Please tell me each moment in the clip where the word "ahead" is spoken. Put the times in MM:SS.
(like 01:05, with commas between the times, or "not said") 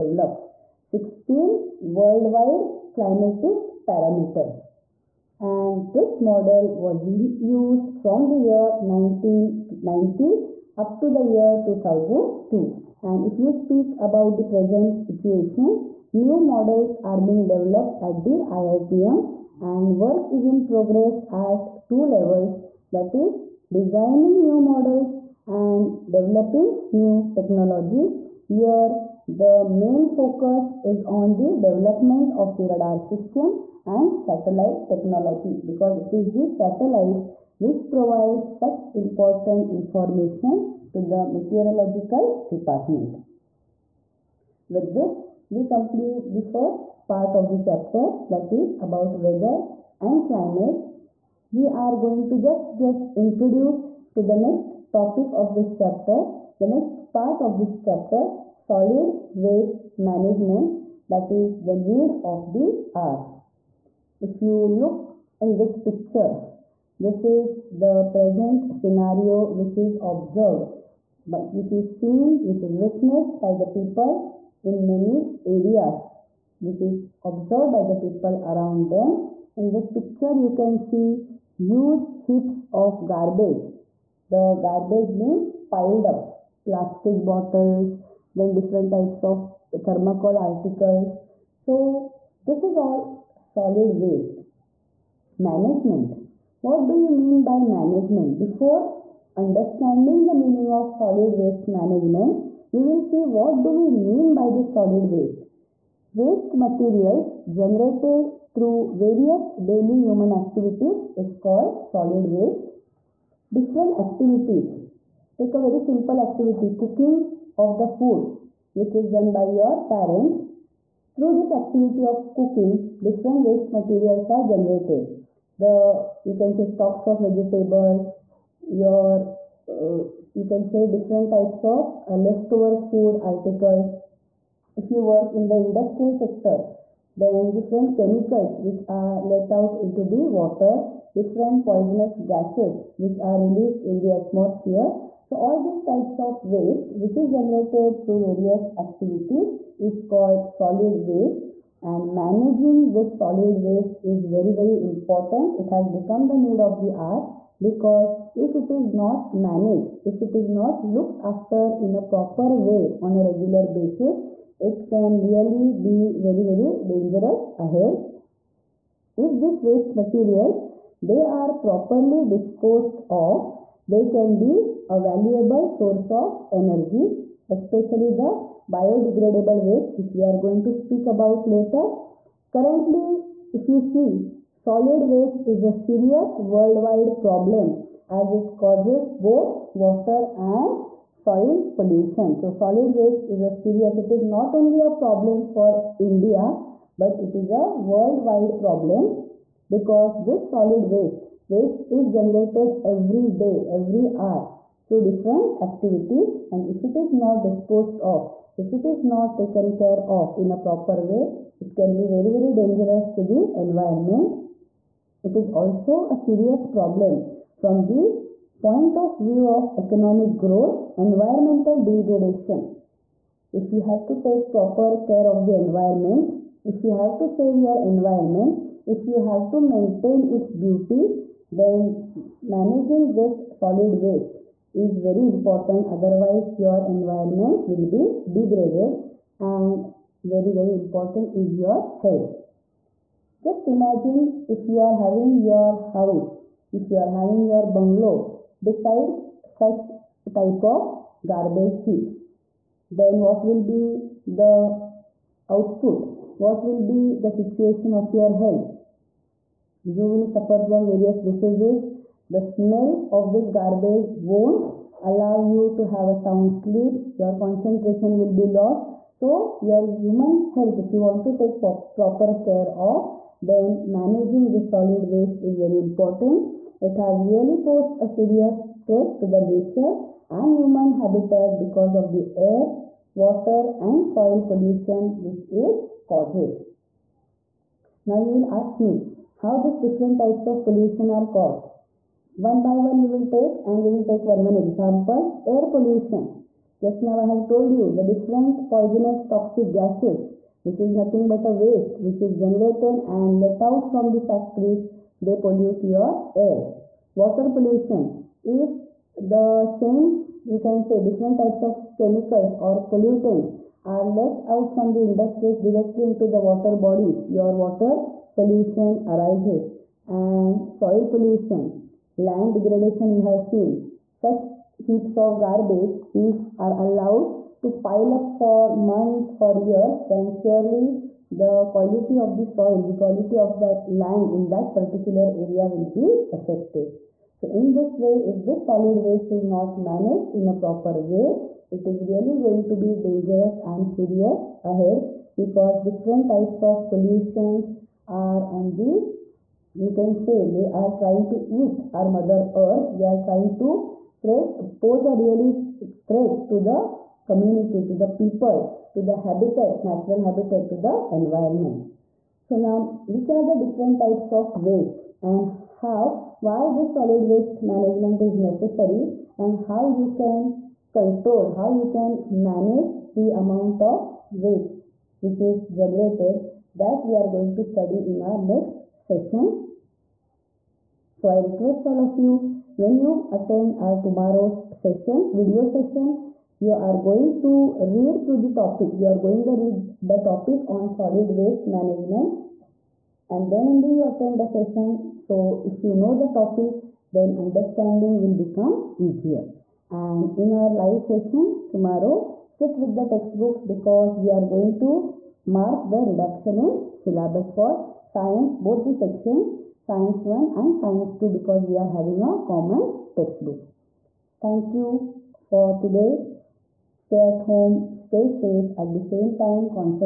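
02:47, 05:44.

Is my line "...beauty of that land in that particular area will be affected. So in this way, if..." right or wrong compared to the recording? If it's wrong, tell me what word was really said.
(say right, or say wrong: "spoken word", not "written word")
wrong: "quality", not "beauty".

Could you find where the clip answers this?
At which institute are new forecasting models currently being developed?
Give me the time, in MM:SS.
00:18.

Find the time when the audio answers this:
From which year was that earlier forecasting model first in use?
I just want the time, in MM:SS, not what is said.
00:08.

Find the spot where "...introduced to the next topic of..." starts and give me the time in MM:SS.
00:53.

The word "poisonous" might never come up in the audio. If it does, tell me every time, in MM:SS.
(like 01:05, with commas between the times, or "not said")
02:21, 04:58.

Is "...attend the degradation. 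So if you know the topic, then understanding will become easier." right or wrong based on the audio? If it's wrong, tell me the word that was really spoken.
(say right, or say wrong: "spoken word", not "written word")
wrong: "session", not "degradation".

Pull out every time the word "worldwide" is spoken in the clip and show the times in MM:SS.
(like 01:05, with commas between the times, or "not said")
00:01, 03:06, 03:17.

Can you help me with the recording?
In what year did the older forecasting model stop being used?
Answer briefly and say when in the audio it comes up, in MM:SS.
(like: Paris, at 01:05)
2002, at 00:11.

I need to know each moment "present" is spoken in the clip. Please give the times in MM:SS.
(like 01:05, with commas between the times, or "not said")
00:14, 01:08.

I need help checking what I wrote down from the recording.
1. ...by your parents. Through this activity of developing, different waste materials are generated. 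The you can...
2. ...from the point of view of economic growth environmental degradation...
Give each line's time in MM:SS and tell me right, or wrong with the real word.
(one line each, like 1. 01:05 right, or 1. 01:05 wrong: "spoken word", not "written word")
1. 01:59 wrong: "cooking", not "developing"
2. 03:37 right.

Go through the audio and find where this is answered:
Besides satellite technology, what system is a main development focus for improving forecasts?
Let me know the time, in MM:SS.
00:32.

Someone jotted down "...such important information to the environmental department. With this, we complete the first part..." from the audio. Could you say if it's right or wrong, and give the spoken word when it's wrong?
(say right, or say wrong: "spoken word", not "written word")
wrong: "meteorological", not "environmental".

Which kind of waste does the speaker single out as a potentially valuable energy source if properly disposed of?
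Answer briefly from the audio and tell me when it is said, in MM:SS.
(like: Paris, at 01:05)
biodegradable waste, at 02:58.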